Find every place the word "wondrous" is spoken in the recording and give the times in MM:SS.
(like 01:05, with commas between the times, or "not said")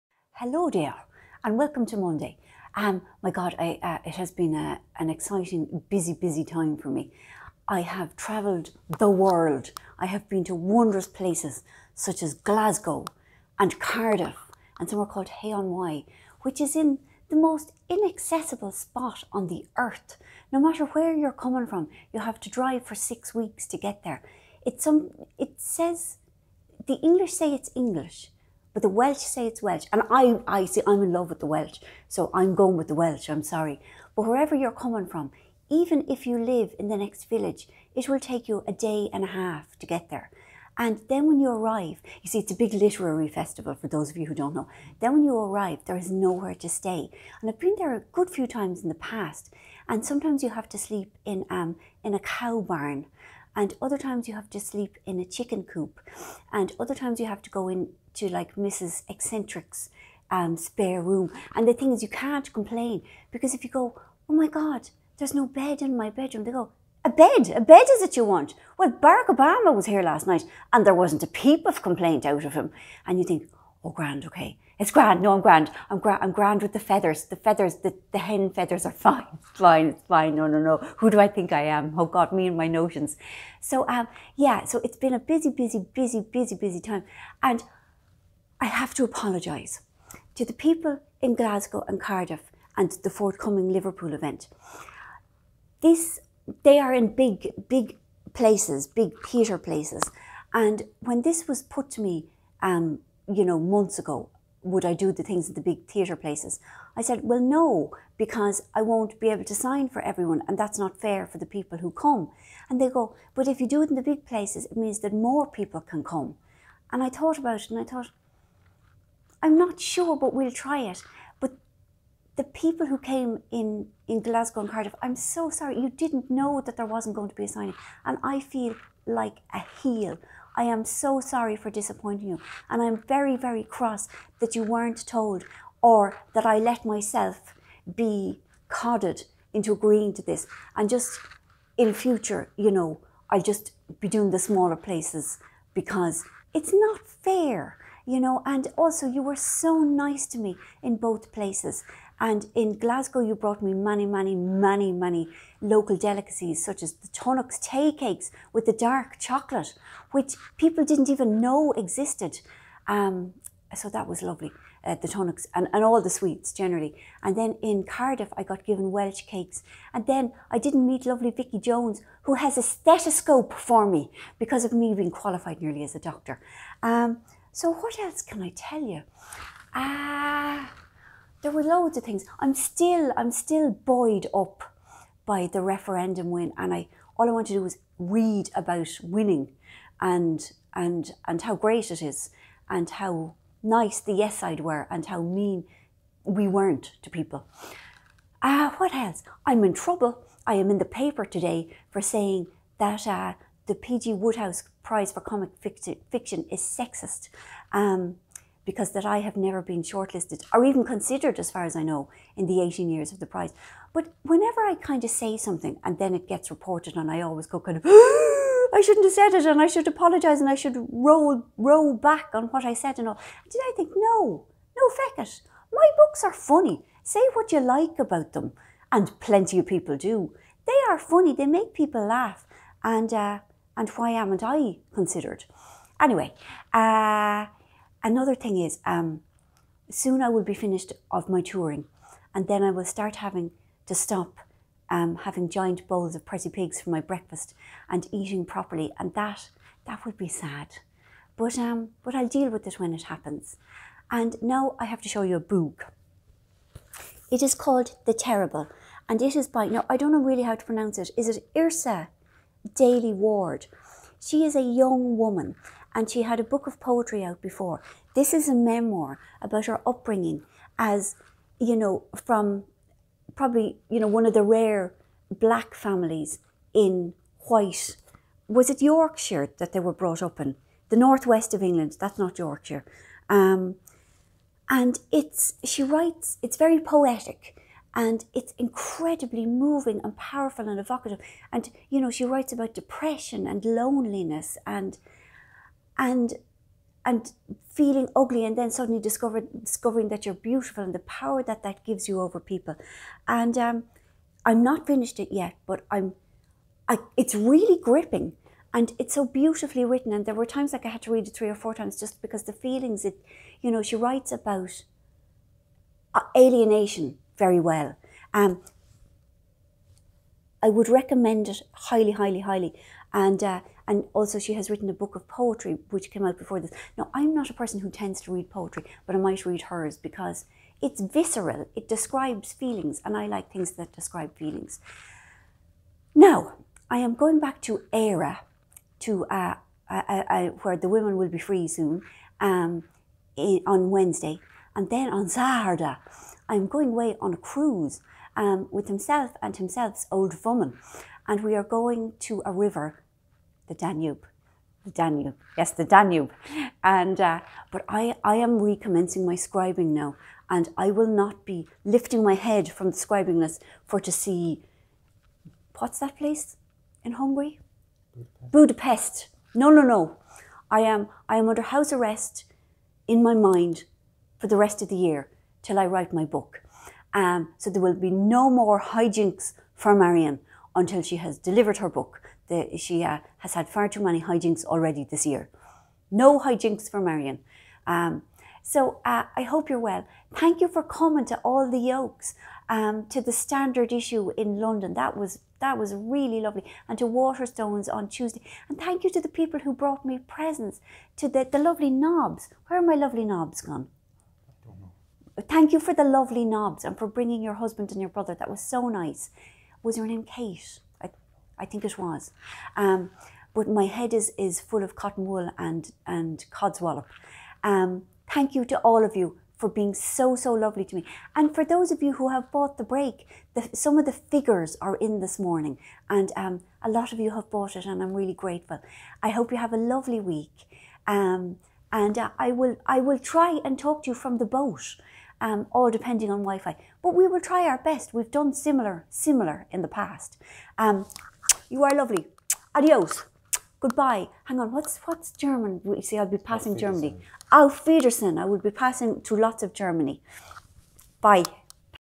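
00:10.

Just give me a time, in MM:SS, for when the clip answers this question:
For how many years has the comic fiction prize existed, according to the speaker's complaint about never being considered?
03:32.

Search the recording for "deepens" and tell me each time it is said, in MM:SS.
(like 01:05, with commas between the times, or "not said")
not said.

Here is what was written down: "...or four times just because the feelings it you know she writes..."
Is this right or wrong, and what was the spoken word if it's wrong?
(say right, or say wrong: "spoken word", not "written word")
right.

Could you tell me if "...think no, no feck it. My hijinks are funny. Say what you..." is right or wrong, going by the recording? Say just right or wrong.
wrong.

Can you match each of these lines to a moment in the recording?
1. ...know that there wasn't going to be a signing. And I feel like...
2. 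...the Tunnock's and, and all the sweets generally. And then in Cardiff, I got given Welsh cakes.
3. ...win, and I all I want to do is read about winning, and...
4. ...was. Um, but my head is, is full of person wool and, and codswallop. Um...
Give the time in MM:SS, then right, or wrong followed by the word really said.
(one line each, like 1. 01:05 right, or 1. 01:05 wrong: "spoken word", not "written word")
1. 02:06 right
2. 02:45 right
3. 03:06 right
4. 06:51 wrong: "cotton", not "person".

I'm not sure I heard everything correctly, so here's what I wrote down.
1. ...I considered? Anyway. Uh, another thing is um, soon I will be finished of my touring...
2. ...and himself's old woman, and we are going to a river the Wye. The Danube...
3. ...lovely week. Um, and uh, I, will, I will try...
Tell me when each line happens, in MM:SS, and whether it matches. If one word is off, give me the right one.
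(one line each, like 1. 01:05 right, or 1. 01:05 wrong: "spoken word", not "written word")
1. 03:54 right
2. 05:49 wrong: "Danube", not "Wye"
3. 07:09 right.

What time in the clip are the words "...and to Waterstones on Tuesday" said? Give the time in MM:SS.
06:36.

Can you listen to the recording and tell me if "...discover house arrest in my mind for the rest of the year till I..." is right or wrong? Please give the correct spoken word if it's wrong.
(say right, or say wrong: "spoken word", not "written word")
wrong: "under", not "discover".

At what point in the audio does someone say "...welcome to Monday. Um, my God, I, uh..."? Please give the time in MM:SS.
00:01.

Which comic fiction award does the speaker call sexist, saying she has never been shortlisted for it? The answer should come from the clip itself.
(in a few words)
P.G. Wodehouse Prize.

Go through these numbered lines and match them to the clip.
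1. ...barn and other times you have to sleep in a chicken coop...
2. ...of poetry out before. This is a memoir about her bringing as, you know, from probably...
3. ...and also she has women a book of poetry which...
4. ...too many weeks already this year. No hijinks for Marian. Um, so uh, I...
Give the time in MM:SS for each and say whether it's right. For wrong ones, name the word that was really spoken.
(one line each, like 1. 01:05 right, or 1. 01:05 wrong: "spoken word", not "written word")
1. 00:52 right
2. 04:26 wrong: "upbringing", not "bringing"
3. 05:23 wrong: "written", not "women"
4. 06:23 wrong: "hijinks", not "weeks".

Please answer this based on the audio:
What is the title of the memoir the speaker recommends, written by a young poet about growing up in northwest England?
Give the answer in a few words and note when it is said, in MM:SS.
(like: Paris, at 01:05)
The Terrible, at 04:18.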